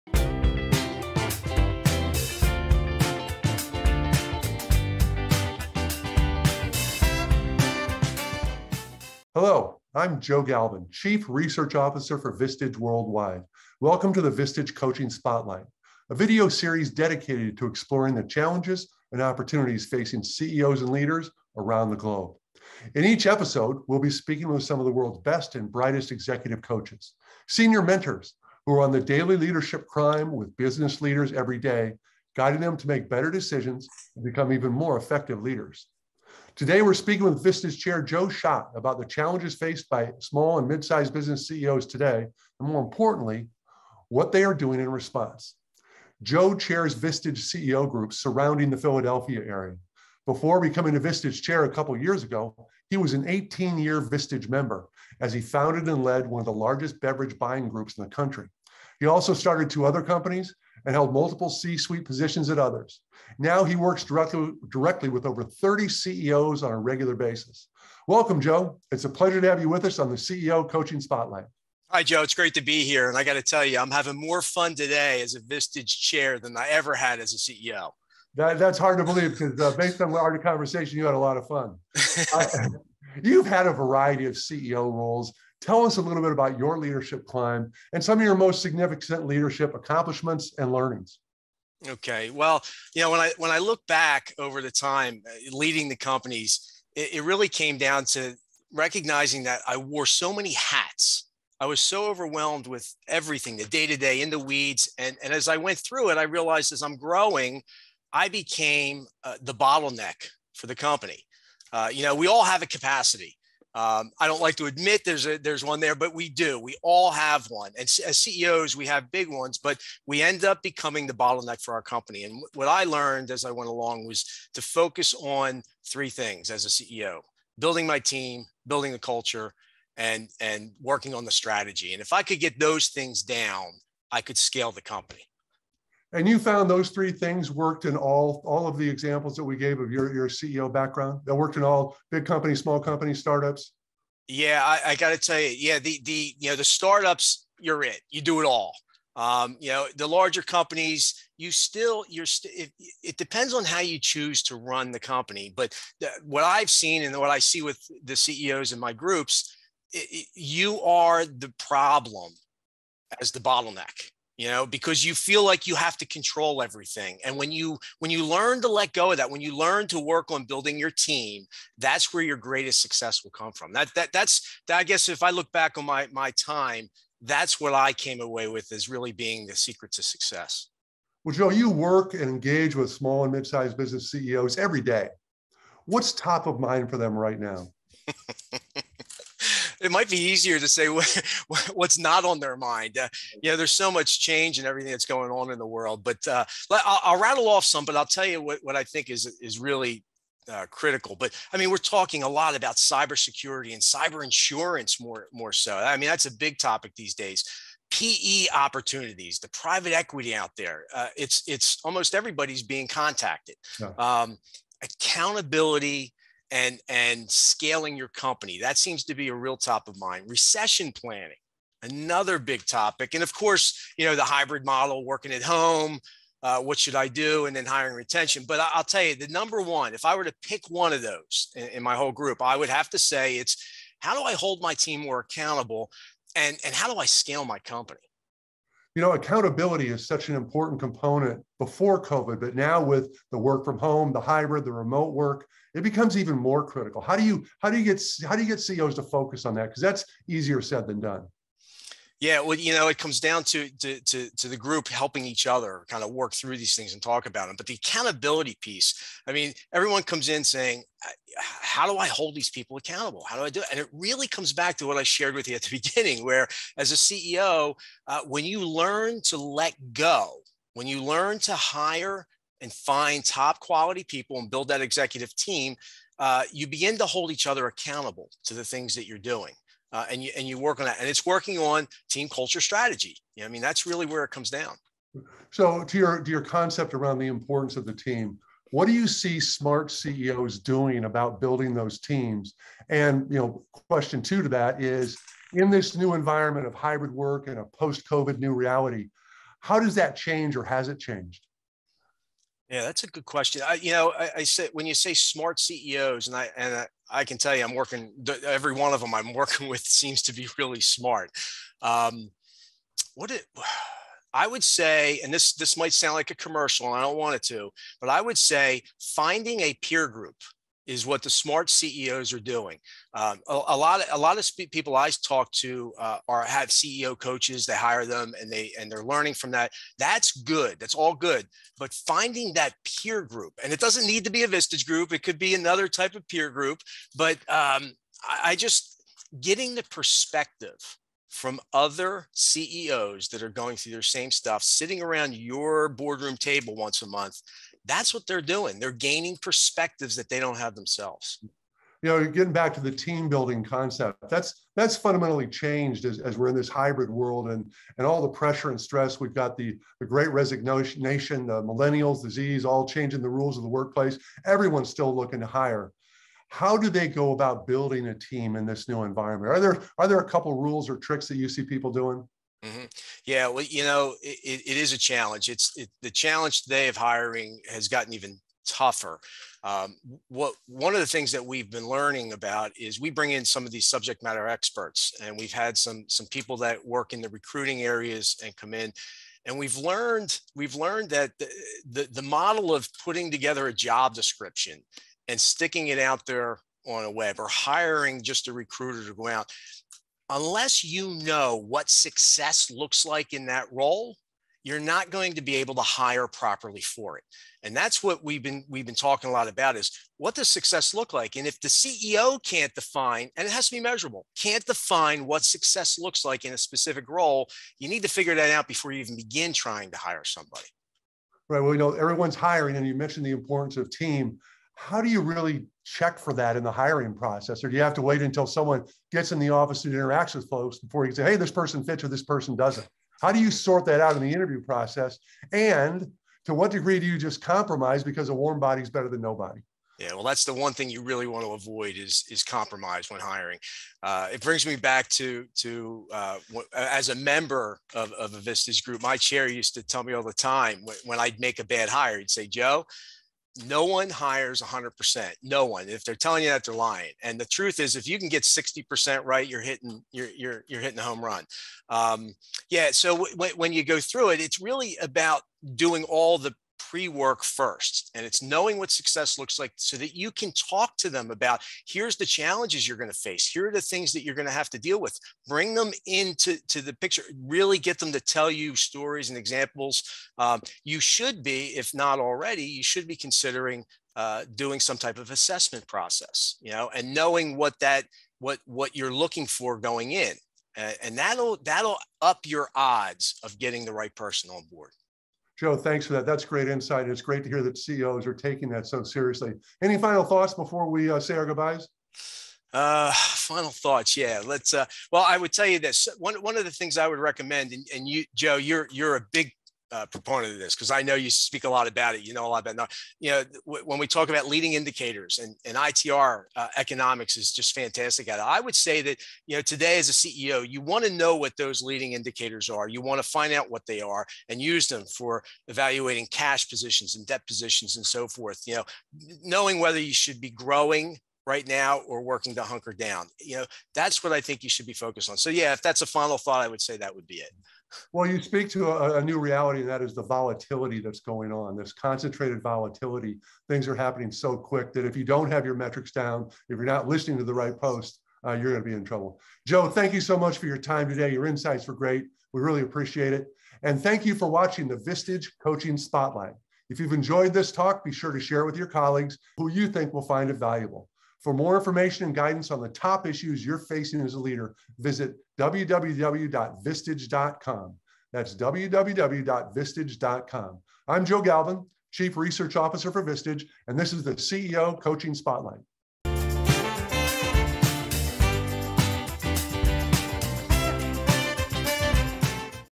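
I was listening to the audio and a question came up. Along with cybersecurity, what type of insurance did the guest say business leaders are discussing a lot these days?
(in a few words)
cyber insurance.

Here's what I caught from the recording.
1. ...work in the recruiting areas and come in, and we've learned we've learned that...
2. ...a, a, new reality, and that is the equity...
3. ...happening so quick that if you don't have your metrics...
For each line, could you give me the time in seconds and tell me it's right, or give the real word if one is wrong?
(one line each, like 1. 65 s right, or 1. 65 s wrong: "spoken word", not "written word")
1. 386 s right
2. 538 s wrong: "volatility", not "equity"
3. 543 s right.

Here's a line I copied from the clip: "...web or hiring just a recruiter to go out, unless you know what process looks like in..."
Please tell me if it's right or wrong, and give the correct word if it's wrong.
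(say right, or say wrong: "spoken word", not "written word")
wrong: "success", not "process".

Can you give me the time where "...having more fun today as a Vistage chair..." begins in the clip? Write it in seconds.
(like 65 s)
73 s.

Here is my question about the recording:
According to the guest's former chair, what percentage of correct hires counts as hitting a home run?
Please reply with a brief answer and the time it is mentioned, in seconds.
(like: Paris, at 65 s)
60%, at 458 s.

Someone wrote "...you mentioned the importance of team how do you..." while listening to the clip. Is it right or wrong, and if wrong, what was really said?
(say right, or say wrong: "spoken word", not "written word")
right.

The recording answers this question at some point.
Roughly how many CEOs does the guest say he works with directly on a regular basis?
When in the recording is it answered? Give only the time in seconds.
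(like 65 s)
65 s.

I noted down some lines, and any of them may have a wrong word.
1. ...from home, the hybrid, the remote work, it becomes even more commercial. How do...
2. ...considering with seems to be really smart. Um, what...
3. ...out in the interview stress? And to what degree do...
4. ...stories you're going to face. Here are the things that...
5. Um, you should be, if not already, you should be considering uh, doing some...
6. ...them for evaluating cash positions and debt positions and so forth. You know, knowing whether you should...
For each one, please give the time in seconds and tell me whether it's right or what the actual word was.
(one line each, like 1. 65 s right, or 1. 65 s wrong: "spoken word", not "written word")
1. 243 s wrong: "critical", not "commercial"
2. 309 s wrong: "working", not "considering"
3. 434 s wrong: "process", not "stress"
4. 472 s wrong: "challenges", not "stories"
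5. 480 s right
6. 524 s right.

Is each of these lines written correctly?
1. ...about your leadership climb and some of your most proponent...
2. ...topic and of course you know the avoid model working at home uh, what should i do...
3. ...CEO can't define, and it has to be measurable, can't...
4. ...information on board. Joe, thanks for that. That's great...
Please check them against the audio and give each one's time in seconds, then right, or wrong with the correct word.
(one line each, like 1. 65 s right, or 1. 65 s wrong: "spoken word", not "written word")
1. 86 s wrong: "significant", not "proponent"
2. 222 s wrong: "hybrid", not "avoid"
3. 411 s right
4. 494 s wrong: "person", not "information".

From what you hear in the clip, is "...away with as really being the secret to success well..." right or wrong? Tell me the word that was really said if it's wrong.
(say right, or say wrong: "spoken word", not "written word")
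right.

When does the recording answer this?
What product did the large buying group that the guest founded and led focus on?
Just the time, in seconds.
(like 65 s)
57 s.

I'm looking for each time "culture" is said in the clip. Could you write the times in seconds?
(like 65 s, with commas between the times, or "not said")
128 s, 282 s.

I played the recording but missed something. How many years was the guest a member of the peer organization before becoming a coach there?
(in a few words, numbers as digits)
18.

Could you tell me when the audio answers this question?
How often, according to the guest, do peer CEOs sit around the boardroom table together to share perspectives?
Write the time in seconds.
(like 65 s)
346 s.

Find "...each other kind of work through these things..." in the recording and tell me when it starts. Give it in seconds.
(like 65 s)
255 s.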